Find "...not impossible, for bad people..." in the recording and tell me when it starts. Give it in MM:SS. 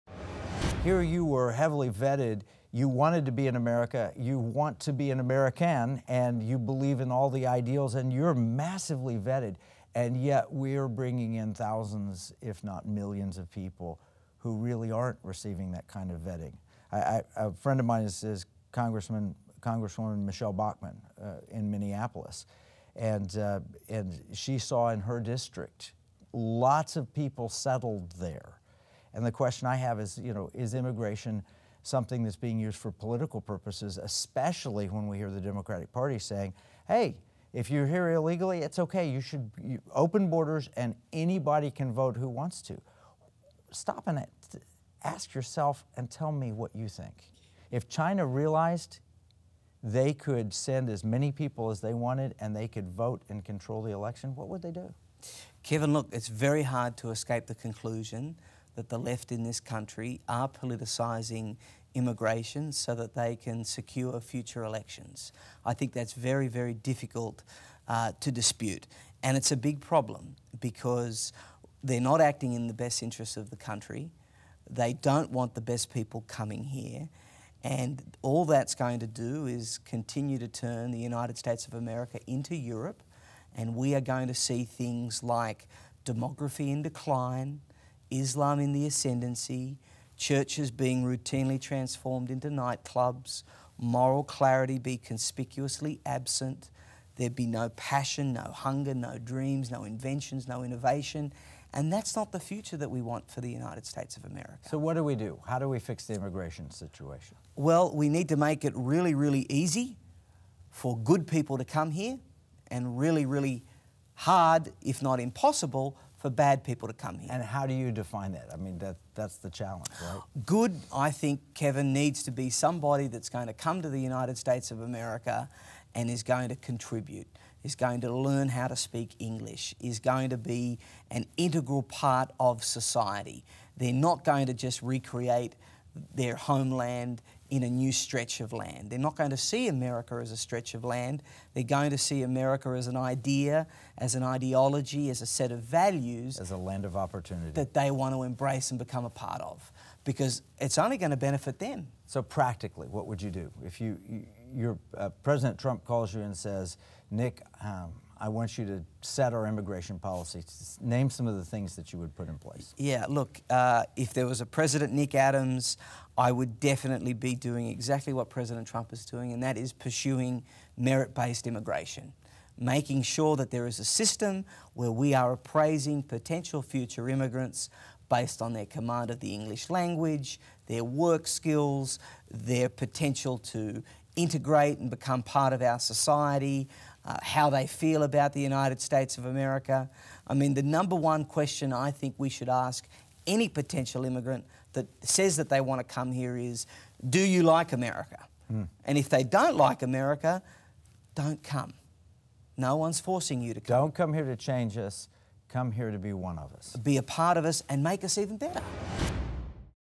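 01:55.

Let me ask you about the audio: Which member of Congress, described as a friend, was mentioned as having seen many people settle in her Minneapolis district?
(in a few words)
Michele Bachmann.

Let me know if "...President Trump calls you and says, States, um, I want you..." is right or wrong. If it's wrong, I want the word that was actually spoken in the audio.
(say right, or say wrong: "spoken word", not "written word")
wrong: "Nick", not "States".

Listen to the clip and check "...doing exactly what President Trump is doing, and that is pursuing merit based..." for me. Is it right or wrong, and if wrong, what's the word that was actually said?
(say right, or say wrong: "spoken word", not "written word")
right.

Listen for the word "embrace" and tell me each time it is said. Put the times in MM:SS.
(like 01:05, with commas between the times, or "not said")
02:28.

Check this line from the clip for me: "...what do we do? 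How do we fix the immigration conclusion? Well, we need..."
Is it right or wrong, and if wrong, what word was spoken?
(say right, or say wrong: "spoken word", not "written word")
wrong: "situation", not "conclusion".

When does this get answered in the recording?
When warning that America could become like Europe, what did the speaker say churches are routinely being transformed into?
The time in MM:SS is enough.
01:32.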